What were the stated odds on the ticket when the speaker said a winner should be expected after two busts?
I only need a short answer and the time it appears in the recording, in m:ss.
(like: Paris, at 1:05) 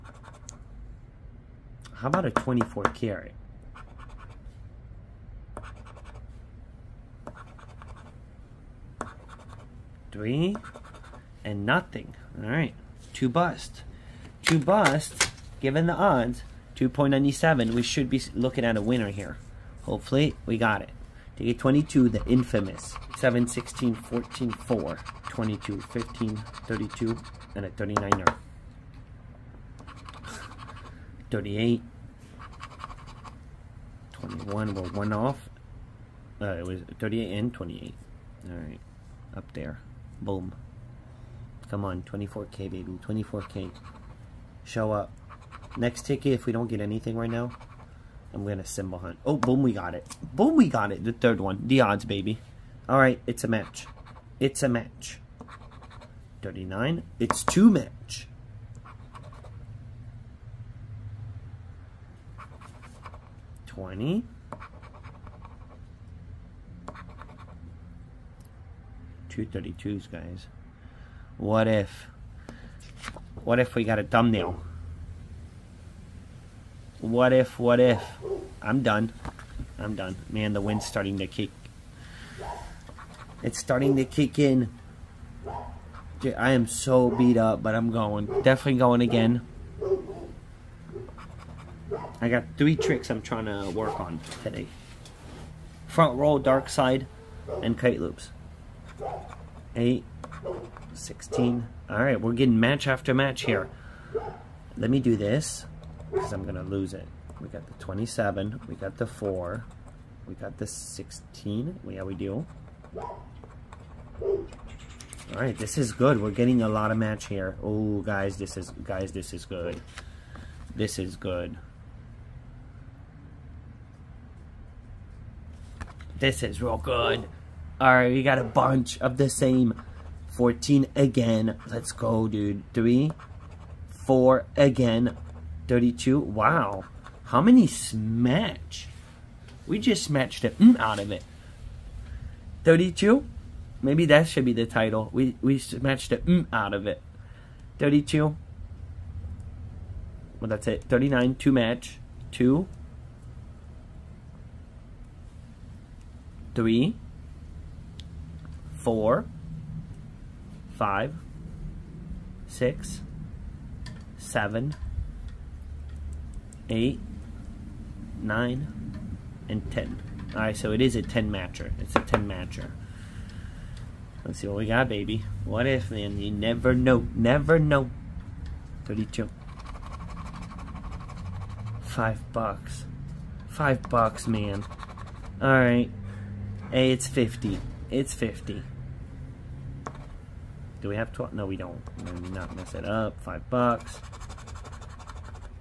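2.97, at 0:16.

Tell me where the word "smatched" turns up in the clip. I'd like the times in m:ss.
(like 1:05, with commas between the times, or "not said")
2:20, 2:25.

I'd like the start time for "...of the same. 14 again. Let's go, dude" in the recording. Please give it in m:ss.
2:09.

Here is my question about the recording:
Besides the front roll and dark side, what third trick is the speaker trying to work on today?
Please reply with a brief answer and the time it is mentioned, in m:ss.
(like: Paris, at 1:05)
Kite loops, at 1:37.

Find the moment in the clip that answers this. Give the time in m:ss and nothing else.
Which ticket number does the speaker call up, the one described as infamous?
0:21.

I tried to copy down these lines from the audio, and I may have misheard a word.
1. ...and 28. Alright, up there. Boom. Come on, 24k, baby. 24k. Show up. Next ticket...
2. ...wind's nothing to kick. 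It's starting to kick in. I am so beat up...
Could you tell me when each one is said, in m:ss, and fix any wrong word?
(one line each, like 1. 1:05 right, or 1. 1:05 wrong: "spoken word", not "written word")
1. 0:37 right
2. 1:20 wrong: "starting", not "nothing".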